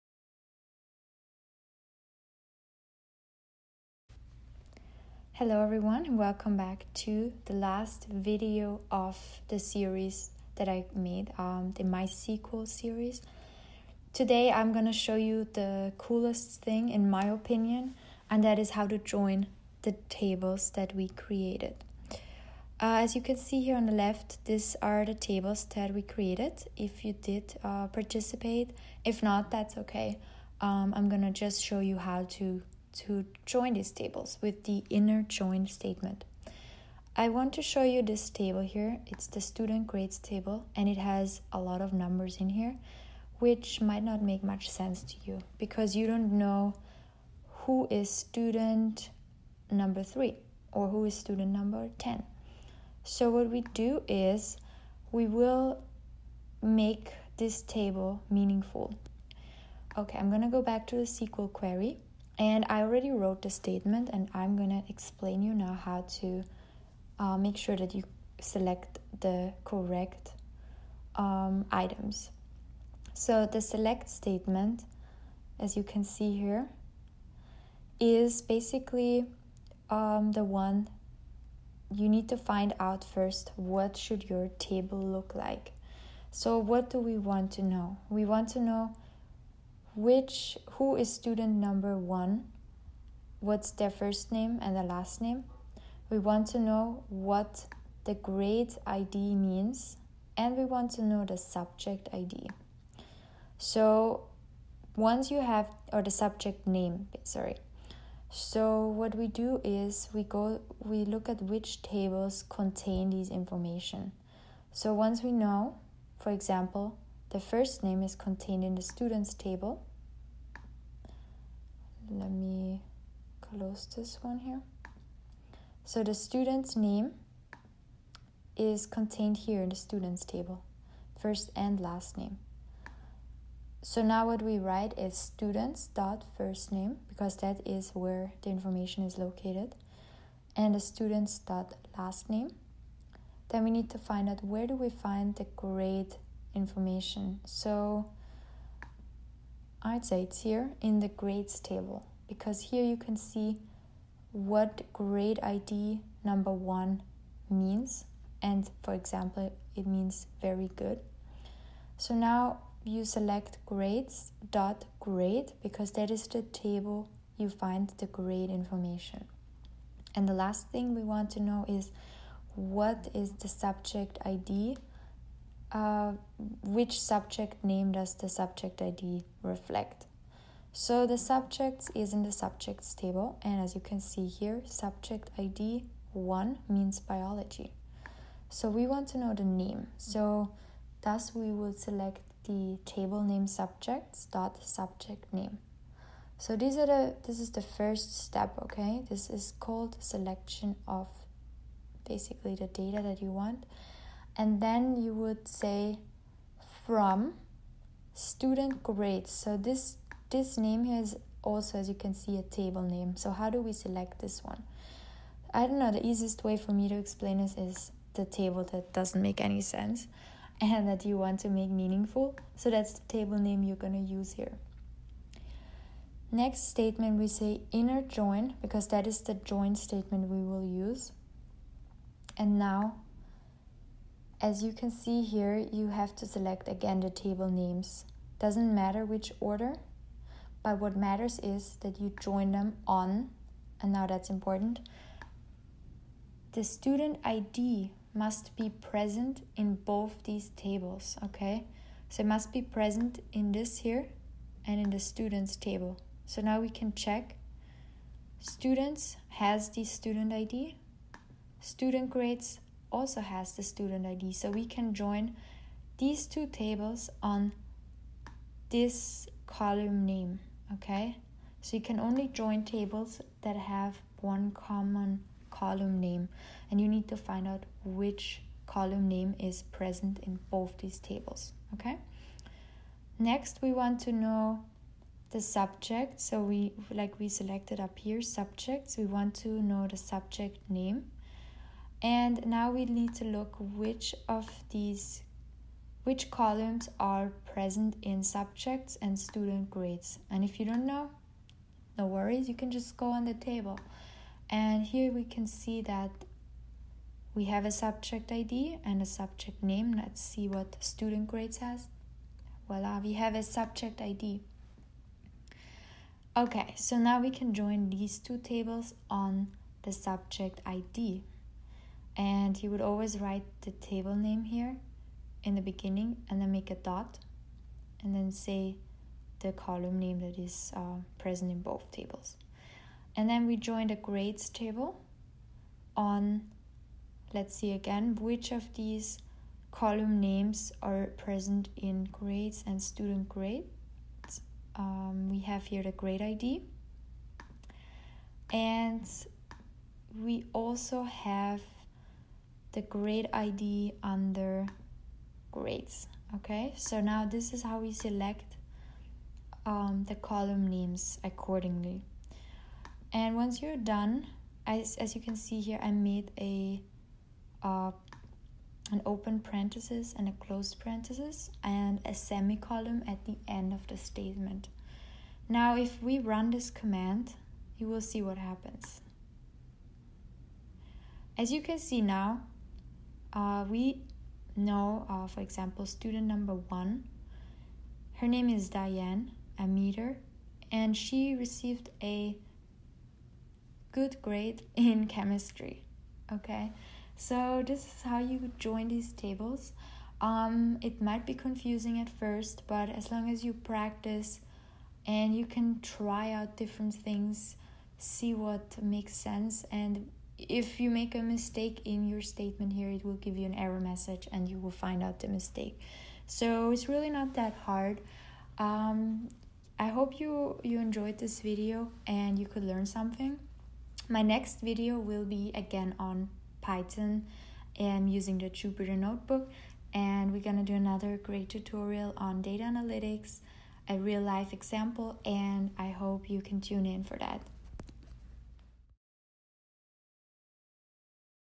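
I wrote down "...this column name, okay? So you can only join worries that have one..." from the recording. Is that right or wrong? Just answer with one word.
wrong.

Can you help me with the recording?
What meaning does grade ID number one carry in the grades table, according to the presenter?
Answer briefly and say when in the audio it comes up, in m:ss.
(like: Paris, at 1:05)
very good, at 2:40.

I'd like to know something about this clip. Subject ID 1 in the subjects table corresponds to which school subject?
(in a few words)
biology.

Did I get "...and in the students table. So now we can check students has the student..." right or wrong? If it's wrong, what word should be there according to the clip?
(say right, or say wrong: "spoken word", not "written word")
right.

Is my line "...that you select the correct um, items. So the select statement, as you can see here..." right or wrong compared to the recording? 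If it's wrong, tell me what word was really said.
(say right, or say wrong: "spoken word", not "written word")
right.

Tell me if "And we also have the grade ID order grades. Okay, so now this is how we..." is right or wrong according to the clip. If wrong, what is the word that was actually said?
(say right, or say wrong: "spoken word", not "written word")
wrong: "under", not "order".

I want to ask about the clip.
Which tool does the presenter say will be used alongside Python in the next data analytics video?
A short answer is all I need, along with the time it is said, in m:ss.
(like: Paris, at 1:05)
Jupyter Notebook, at 7:08.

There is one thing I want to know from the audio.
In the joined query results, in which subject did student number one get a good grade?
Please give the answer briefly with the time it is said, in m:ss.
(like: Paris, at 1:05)
chemistry, at 6:35.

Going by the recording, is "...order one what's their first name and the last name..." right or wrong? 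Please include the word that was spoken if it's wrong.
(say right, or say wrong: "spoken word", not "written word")
wrong: "number", not "order".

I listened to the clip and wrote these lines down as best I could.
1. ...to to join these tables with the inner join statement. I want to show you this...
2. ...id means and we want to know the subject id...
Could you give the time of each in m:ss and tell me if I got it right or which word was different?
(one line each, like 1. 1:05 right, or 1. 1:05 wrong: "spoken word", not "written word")
1. 0:32 right
2. 1:38 right.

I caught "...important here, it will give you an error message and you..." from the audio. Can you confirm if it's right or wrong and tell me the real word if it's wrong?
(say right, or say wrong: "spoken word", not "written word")
wrong: "statement", not "important".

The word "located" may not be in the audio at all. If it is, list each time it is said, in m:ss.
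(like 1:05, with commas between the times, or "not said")
2:19.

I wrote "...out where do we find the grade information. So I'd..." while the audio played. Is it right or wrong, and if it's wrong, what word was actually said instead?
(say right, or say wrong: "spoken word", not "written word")
right.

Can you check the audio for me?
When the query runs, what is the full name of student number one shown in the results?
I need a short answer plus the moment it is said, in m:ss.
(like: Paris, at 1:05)
Diane Ameter, at 6:28.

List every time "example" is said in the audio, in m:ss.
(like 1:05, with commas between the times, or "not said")
1:56, 2:38, 6:25, 7:14.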